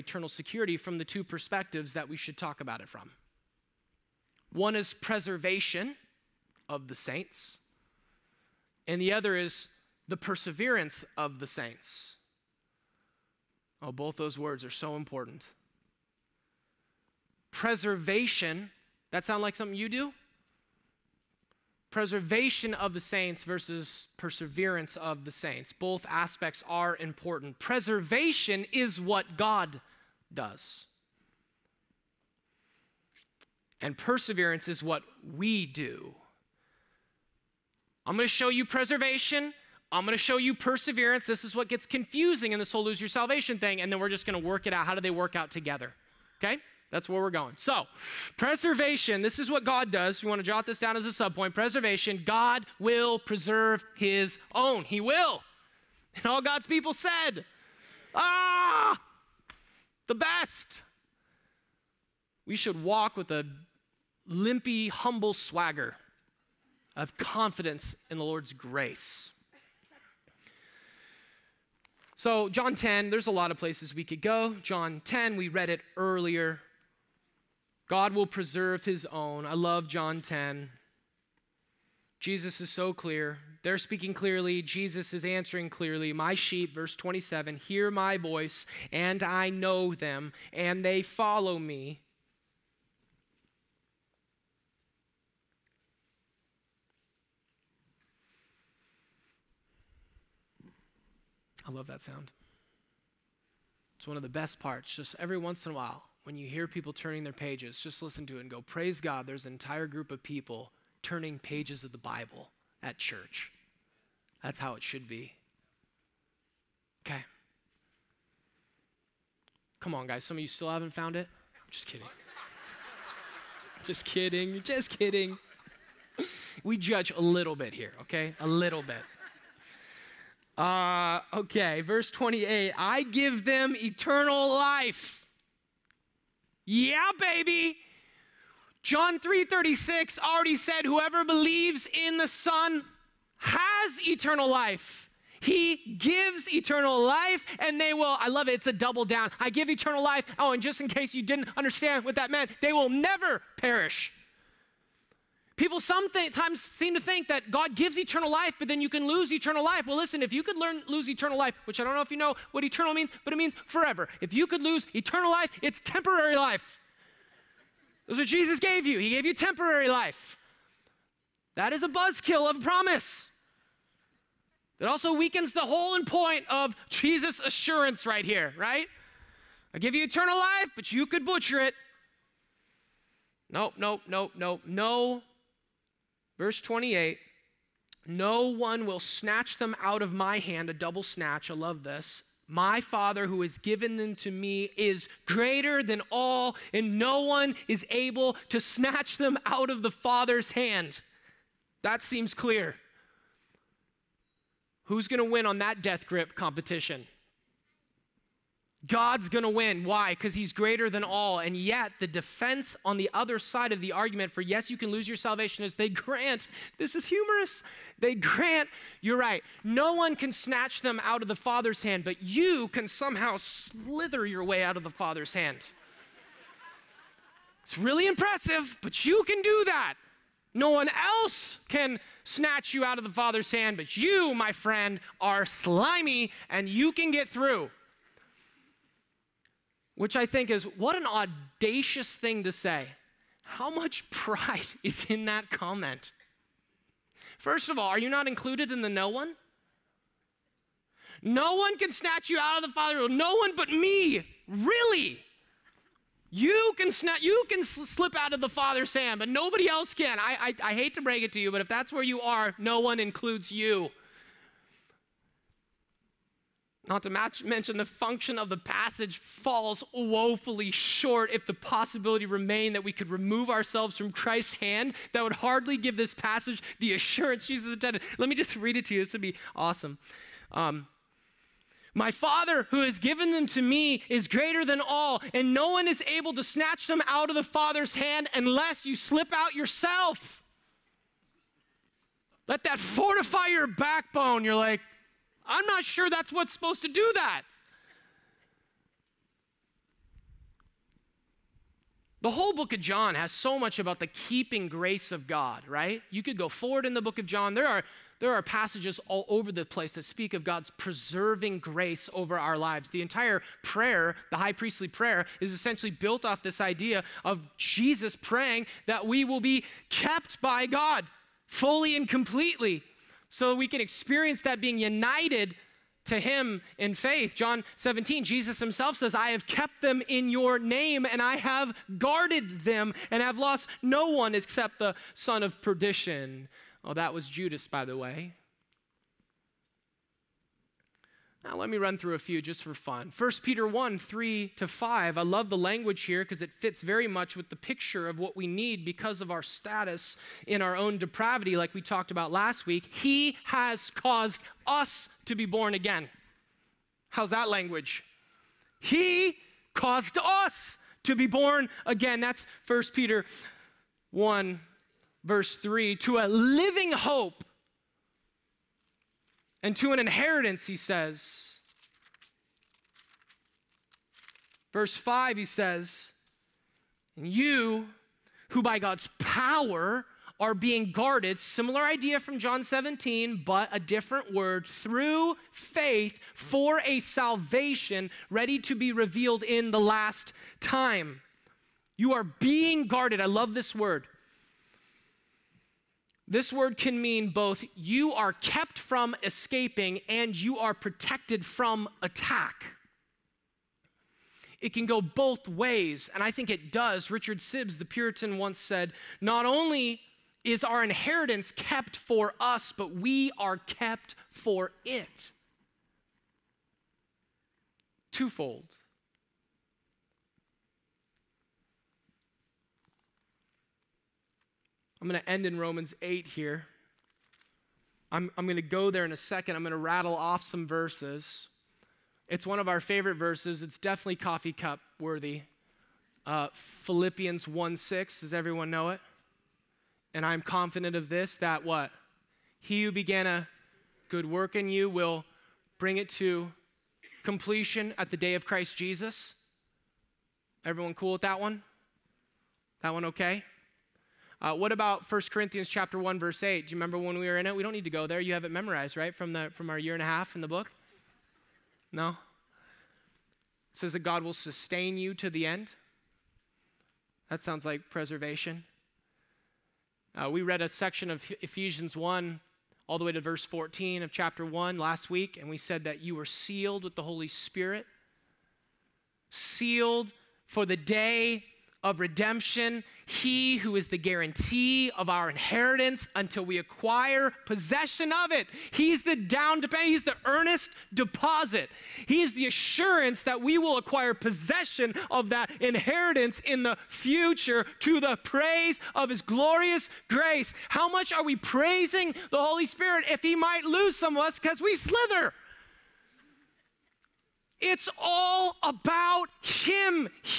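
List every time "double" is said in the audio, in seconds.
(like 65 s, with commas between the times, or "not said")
148 s, 190 s.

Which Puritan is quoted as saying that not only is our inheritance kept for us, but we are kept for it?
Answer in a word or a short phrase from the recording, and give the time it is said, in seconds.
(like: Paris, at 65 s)
Richard Sibbes, at 407 s.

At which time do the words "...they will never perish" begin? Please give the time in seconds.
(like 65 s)
152 s.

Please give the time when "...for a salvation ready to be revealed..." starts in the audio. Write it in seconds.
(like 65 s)
386 s.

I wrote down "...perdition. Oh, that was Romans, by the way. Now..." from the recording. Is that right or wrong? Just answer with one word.
wrong.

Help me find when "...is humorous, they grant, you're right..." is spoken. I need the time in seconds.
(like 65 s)
216 s.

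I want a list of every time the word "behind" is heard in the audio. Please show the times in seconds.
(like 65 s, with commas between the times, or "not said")
not said.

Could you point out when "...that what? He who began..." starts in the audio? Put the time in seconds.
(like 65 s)
441 s.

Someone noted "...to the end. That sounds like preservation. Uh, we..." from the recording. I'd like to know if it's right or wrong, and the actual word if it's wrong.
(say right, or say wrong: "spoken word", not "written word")
right.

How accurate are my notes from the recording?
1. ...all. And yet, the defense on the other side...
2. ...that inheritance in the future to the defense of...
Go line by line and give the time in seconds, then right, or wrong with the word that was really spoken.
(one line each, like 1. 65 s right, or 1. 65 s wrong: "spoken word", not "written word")
1. 211 s right
2. 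495 s wrong: "praise", not "defense".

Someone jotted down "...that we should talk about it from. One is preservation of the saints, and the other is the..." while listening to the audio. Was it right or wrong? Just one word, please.
right.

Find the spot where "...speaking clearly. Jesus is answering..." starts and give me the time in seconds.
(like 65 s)
83 s.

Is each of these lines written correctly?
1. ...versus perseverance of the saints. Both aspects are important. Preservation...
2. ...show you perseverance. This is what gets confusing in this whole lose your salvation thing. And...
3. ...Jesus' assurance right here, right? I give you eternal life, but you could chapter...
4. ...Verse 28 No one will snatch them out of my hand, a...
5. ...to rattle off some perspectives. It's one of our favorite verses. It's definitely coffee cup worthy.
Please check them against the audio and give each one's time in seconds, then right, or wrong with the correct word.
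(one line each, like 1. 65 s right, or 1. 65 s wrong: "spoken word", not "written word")
1. 23 s right
2. 40 s right
3. 176 s wrong: "butcher", not "chapter"
4. 186 s right
5. 429 s wrong: "verses", not "perspectives".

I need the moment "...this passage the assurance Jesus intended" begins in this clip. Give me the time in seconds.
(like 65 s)
275 s.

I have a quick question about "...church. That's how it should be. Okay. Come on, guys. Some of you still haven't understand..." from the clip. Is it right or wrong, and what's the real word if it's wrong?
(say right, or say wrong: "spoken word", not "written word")
wrong: "found", not "understand".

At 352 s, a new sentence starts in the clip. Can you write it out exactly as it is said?
He has caused us to be born again.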